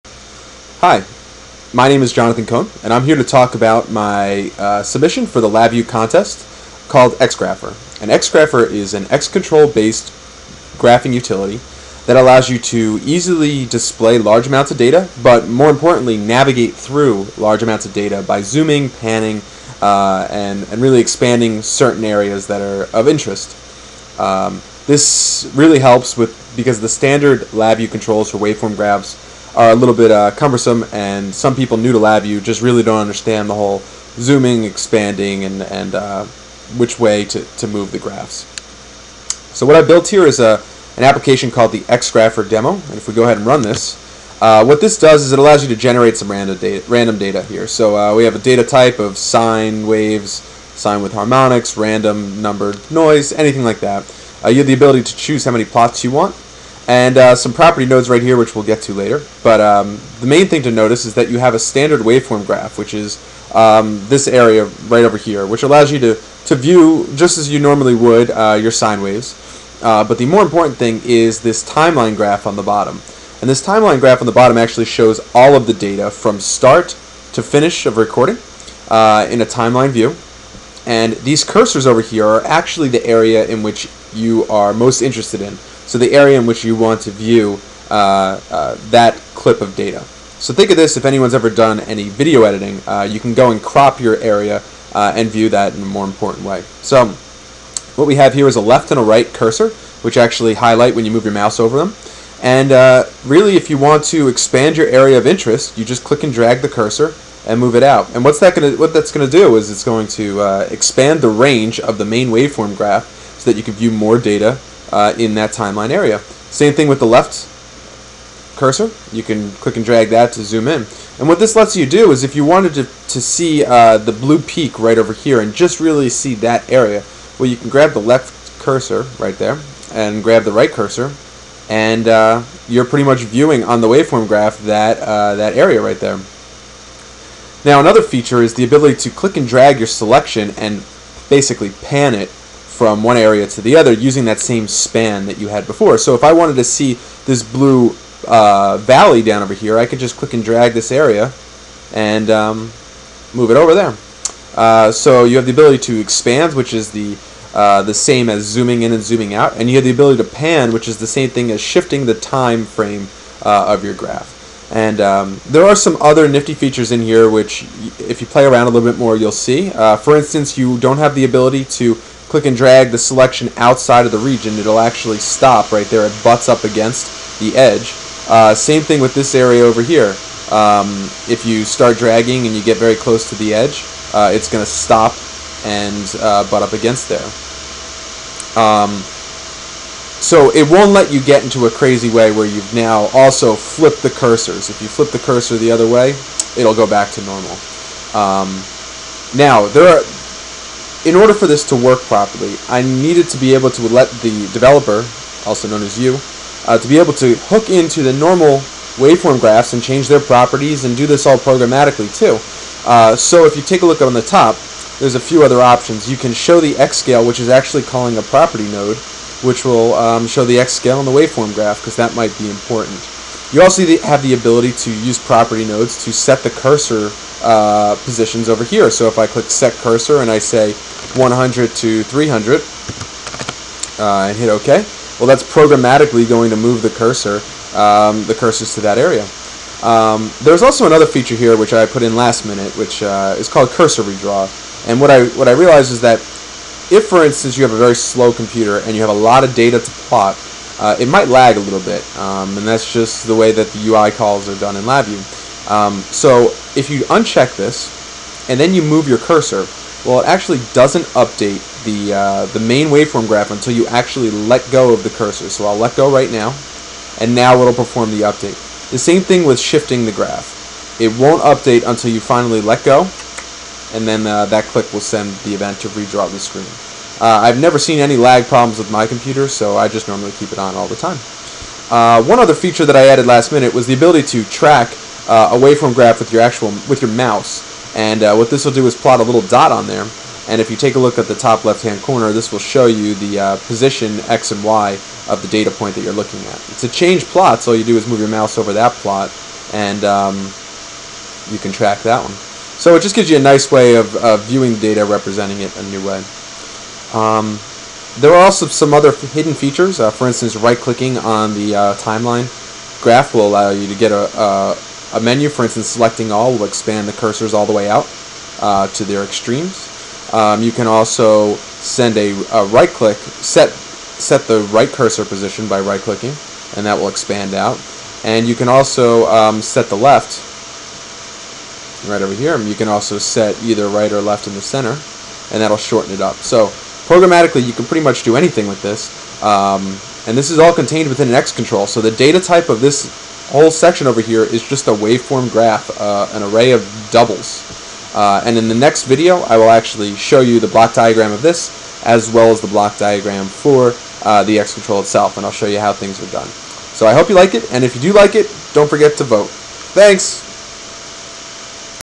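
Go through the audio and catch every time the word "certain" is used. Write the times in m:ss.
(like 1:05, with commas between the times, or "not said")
0:21.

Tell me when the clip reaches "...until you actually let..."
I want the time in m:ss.
4:23.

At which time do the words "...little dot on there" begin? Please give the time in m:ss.
4:49.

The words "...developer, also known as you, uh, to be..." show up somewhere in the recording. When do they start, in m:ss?
3:24.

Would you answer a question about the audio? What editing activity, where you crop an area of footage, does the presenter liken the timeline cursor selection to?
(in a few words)
video editing.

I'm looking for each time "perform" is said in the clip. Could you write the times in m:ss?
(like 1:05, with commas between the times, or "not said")
4:27.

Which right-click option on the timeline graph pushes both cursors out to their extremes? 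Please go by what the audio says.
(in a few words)
selecting all.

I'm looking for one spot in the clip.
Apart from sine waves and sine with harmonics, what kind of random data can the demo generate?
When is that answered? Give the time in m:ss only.
0:51.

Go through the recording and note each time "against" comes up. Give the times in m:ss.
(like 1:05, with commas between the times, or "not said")
2:56, 3:06.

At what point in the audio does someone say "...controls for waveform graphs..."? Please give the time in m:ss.
0:27.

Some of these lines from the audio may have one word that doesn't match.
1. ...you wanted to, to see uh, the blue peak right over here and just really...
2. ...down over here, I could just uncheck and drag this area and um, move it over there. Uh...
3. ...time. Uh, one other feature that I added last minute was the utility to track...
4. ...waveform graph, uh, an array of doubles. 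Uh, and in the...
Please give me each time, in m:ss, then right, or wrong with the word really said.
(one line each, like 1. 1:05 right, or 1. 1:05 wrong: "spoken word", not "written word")
1. 2:02 right
2. 2:29 wrong: "click", not "uncheck"
3. 4:40 wrong: "ability", not "utility"
4. 5:44 right.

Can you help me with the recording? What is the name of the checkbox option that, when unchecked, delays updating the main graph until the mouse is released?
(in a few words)
cursor redraw.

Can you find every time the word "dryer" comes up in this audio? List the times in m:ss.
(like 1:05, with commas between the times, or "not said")
not said.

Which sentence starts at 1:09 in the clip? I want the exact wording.
Uh, but the more important thing is this timeline graph on the bottom.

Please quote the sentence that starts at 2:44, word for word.
And um, there are some other nifty features in here which, if you play around a little bit more, you'll see.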